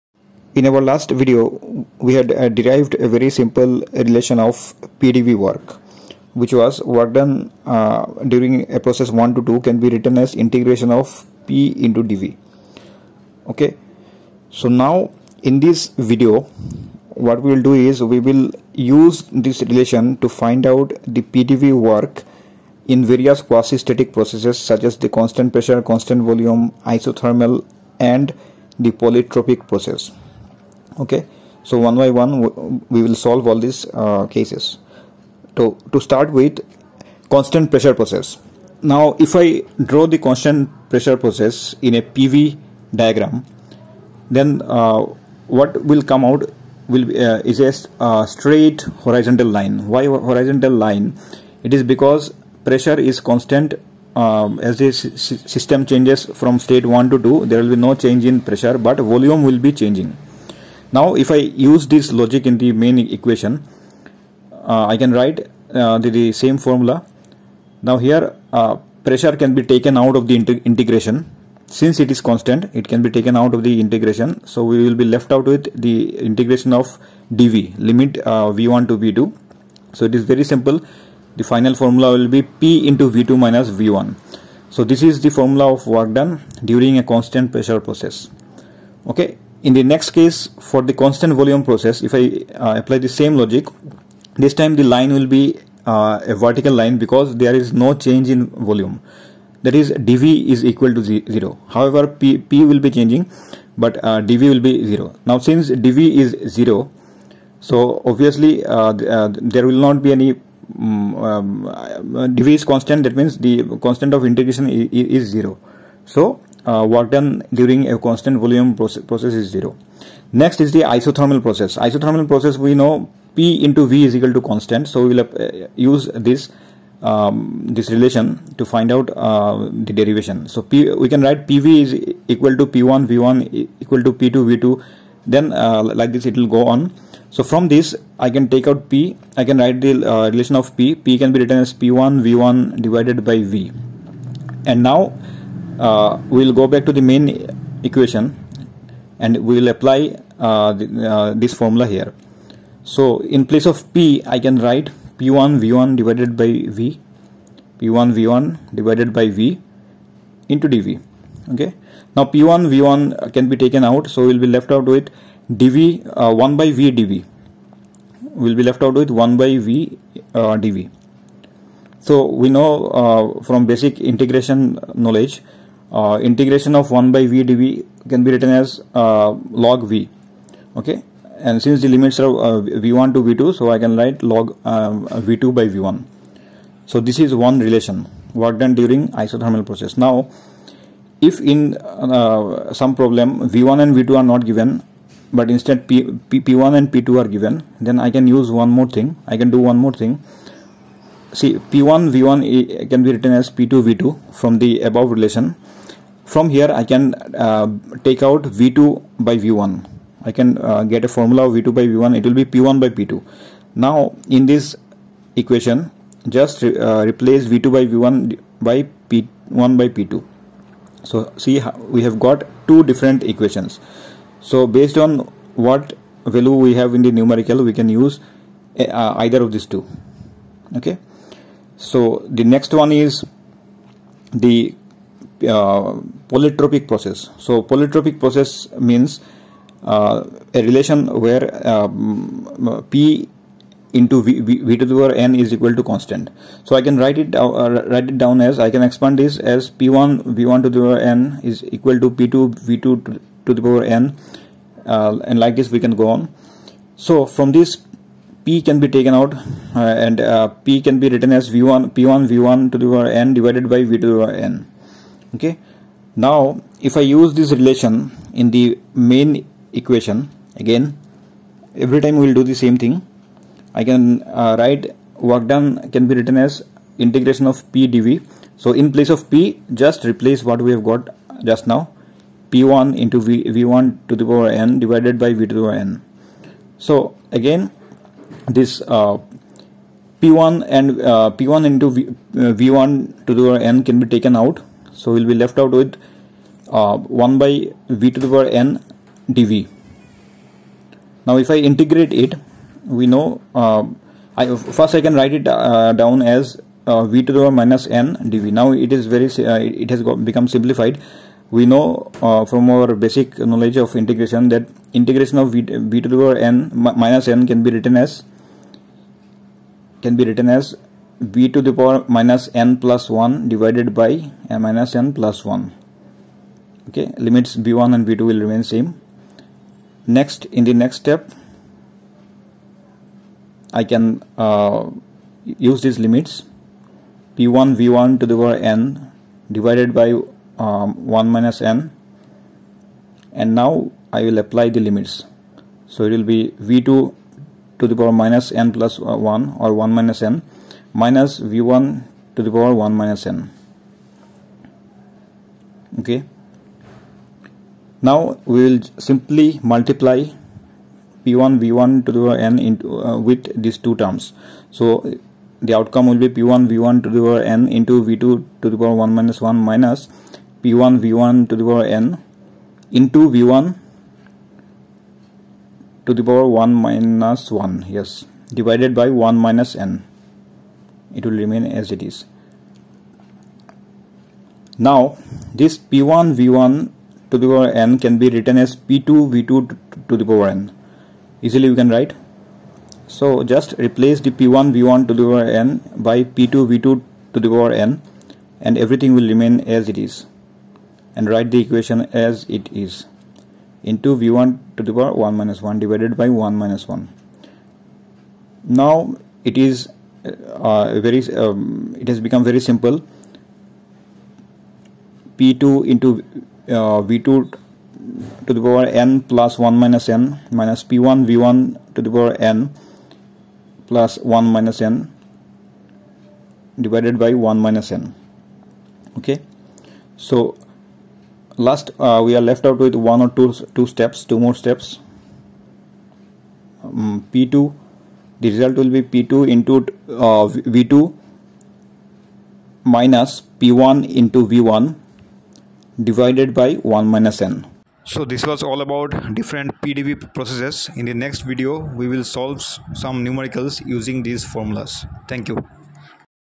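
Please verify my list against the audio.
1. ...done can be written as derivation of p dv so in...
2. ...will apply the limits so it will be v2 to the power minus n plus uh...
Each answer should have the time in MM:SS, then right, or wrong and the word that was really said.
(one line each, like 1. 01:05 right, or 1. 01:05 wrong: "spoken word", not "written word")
1. 04:35 wrong: "integration", not "derivation"
2. 05:44 right.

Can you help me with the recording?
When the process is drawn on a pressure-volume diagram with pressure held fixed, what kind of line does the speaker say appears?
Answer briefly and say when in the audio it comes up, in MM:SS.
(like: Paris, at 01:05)
straight horizontal line, at 00:48.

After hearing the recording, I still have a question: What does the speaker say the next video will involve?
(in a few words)
solve some numericals.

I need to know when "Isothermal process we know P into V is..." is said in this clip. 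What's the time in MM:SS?
02:01.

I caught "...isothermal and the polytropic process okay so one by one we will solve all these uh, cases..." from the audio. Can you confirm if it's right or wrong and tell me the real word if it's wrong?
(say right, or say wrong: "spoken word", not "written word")
right.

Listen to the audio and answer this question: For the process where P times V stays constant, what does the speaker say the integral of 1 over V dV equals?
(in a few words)
log v.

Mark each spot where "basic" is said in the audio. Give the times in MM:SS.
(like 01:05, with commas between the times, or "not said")
02:53, 05:12.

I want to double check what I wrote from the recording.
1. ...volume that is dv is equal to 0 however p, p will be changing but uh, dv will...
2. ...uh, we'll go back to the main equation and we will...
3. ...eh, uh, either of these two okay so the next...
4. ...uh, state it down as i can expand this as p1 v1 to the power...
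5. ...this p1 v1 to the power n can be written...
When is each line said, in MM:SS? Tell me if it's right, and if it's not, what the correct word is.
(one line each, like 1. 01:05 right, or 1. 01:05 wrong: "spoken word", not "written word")
1. 01:38 right
2. 02:25 right
3. 03:48 right
4. 04:07 wrong: "write", not "state"
5. 06:25 right.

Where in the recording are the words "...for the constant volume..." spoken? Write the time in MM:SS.
01:30.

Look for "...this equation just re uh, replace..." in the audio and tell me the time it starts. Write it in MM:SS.
03:34.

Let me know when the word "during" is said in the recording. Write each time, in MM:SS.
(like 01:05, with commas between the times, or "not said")
00:08, 01:26, 01:57, 03:08.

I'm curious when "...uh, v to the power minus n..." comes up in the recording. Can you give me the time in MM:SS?
05:06.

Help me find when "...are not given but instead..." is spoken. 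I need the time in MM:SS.
03:14.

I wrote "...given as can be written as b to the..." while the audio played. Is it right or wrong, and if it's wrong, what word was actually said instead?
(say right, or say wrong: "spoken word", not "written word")
wrong: "written", not "given".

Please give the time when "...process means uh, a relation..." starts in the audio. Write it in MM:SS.
03:58.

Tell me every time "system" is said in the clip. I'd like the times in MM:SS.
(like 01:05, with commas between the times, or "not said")
00:54.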